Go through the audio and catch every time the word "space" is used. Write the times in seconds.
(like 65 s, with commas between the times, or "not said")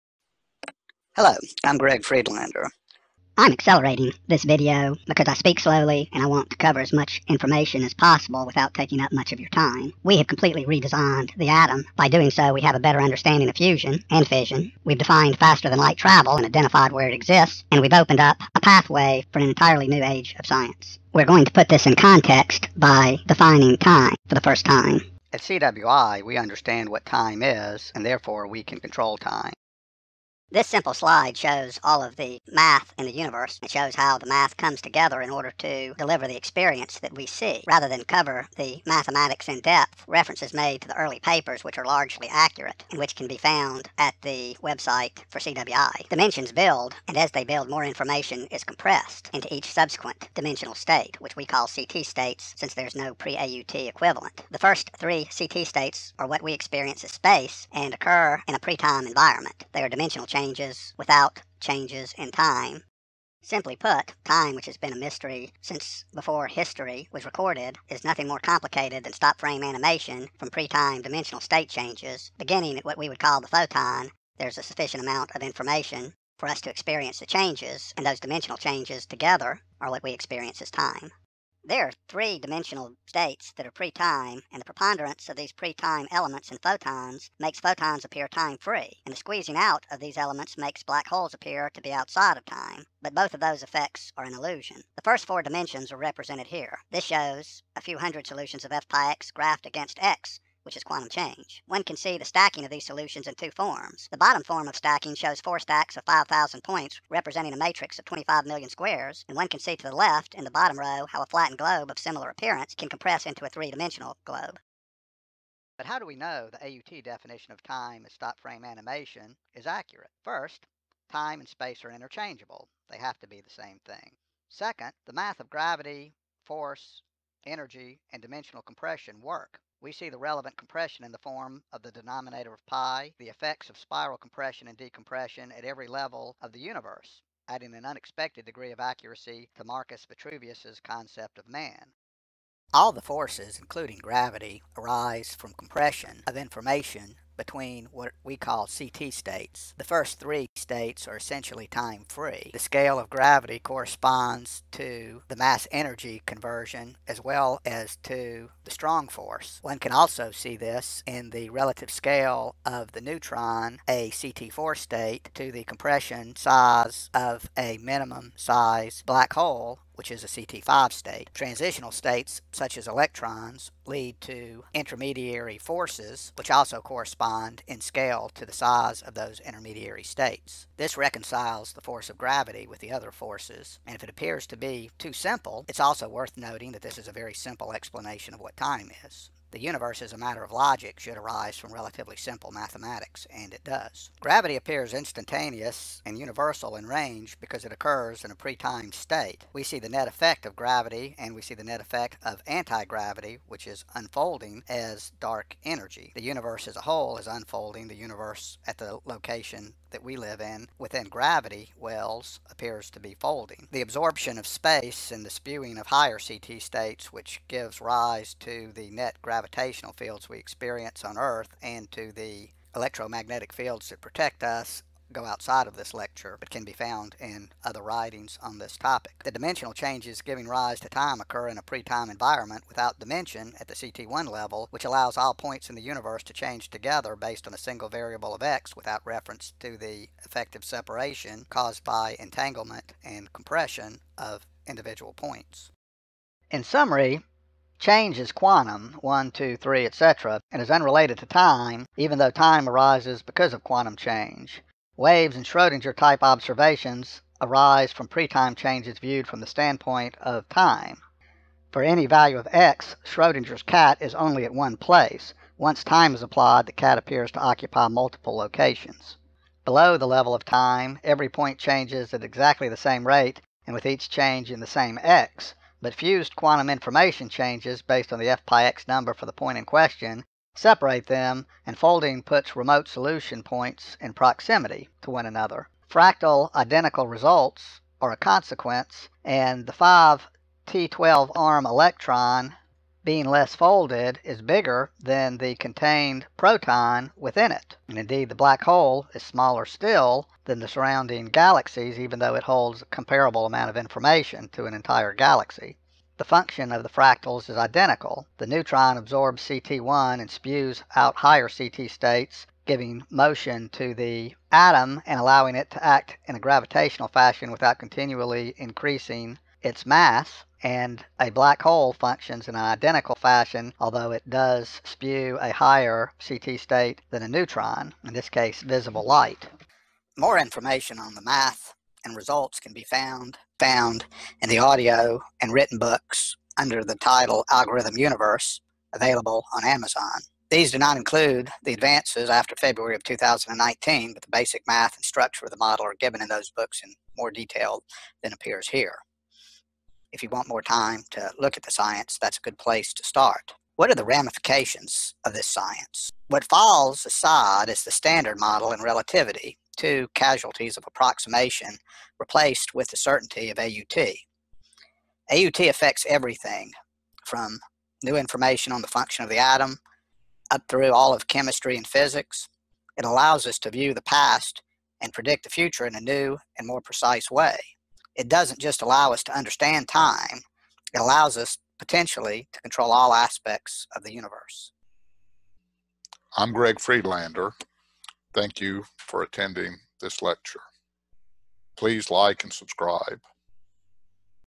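57 s, 121 s, 214 s.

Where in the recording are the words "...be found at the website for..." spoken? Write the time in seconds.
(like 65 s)
43 s.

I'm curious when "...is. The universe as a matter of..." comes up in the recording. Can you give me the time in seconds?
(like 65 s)
189 s.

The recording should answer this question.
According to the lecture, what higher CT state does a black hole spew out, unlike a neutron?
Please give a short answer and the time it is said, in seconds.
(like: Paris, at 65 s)
visible light, at 328 s.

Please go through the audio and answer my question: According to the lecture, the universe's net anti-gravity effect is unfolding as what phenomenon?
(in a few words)
dark energy.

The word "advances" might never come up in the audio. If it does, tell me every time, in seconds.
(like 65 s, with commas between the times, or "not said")
341 s.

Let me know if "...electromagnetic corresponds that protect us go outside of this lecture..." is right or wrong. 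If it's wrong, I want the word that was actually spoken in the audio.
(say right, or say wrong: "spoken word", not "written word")
wrong: "fields", not "corresponds".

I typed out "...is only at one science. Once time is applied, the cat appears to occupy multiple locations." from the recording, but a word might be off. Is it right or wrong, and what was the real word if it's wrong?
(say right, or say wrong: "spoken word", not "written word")
wrong: "place", not "science".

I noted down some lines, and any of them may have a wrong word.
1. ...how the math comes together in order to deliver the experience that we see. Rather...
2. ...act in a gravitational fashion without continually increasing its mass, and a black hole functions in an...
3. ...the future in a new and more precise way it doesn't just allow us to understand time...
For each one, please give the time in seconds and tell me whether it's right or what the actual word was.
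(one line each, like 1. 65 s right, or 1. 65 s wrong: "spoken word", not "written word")
1. 33 s right
2. 315 s right
3. 375 s right.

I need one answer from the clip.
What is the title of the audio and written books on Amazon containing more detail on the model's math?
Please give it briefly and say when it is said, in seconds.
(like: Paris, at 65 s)
Algorithm Universe, at 337 s.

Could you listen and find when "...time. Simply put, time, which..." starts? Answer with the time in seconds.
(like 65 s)
62 s.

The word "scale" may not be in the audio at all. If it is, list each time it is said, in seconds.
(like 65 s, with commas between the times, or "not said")
152 s, 161 s, 177 s.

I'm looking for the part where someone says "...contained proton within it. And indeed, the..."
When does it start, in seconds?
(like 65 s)
295 s.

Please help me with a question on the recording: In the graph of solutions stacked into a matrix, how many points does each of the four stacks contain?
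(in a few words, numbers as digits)
5,000.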